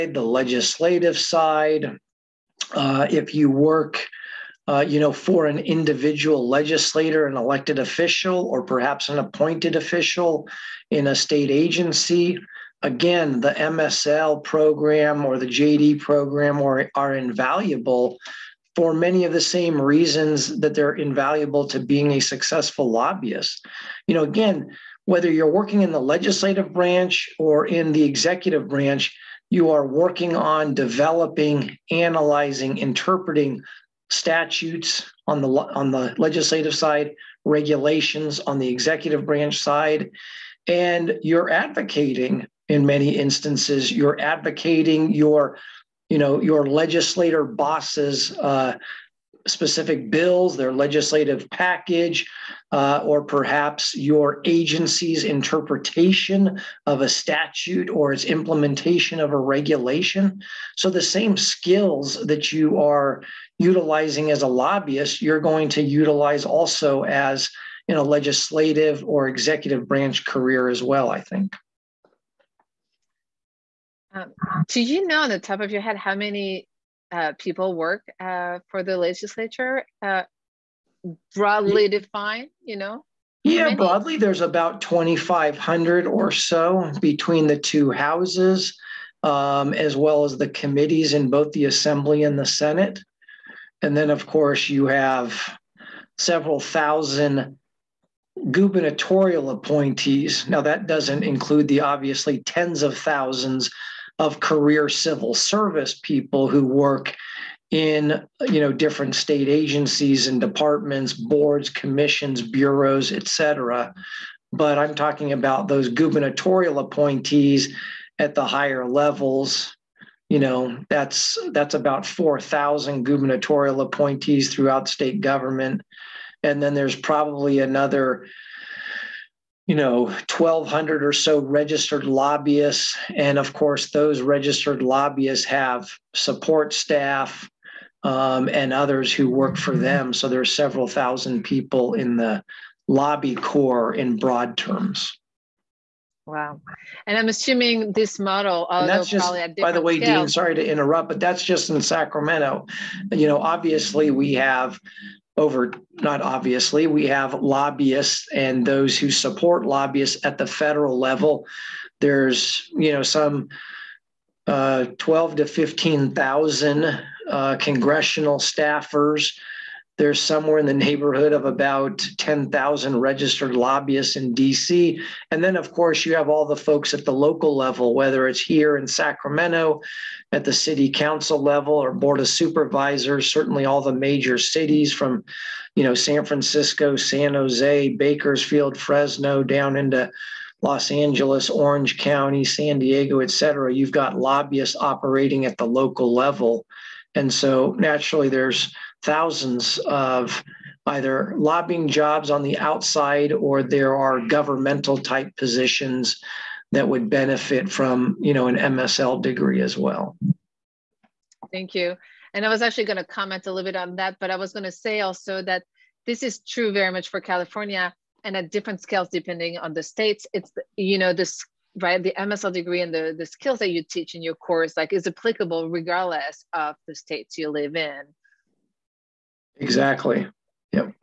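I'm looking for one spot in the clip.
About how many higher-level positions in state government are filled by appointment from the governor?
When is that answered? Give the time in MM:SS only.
02:02.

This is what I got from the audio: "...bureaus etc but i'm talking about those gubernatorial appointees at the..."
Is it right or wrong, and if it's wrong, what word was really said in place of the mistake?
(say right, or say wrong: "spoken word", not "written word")
right.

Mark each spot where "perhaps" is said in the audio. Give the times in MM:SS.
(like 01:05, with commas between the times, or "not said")
00:08, 00:53.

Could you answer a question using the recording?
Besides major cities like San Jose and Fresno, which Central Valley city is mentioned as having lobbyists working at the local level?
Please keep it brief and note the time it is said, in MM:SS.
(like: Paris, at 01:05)
Bakersfield, at 03:07.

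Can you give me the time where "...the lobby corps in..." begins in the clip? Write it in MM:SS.
02:22.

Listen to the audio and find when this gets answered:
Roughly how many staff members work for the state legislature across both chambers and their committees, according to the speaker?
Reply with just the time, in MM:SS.
01:24.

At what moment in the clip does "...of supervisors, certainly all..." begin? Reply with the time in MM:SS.
03:02.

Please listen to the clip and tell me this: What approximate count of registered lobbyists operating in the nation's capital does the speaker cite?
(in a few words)
10,000.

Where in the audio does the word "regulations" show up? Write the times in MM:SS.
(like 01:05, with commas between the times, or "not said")
00:37, 00:59.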